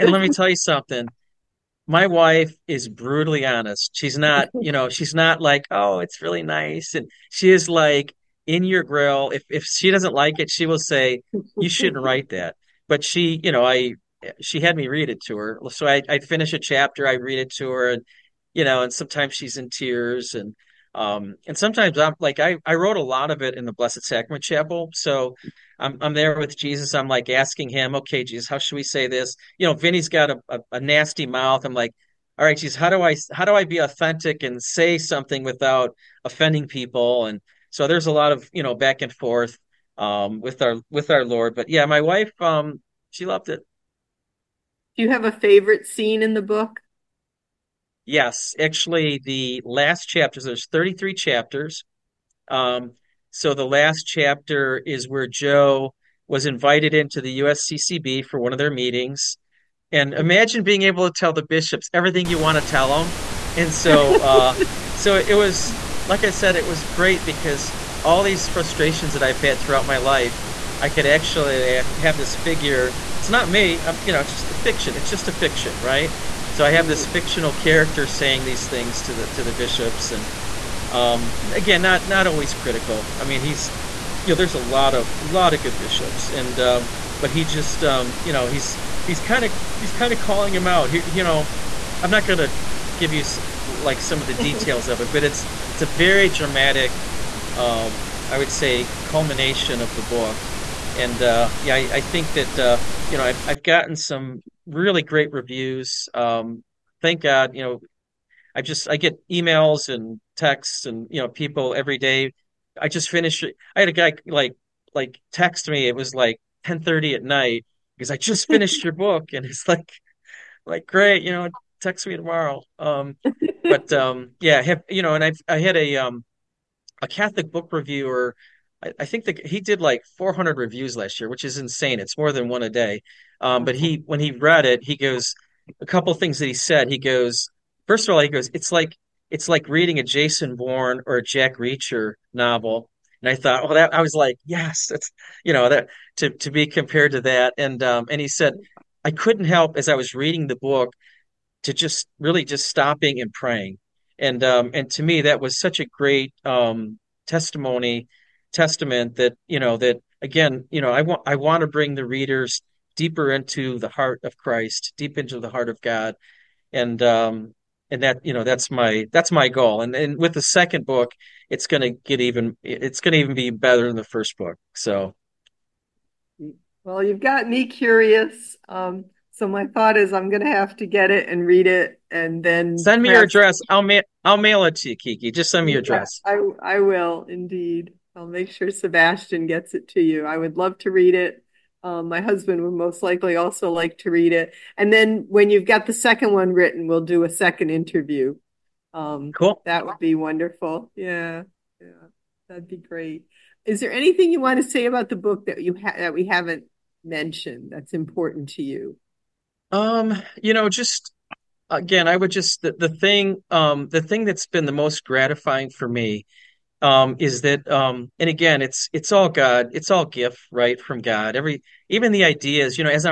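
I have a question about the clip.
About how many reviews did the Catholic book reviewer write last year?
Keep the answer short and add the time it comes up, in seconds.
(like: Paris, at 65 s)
400, at 130 s.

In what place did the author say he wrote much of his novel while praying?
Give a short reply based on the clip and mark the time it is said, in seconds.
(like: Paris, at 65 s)
Blessed Sacrament Chapel, at 23 s.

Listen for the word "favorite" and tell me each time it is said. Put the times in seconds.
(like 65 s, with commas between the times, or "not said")
45 s.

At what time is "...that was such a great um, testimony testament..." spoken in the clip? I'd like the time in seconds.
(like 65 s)
155 s.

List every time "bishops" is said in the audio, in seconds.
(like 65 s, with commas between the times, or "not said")
61 s, 79 s, 85 s.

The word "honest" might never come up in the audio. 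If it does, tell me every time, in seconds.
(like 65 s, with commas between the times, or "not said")
3 s.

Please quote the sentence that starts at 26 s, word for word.
I'm like asking him, okay, Jesus, how should we say this?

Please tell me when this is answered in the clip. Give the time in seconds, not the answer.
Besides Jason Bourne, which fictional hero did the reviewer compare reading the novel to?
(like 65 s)
141 s.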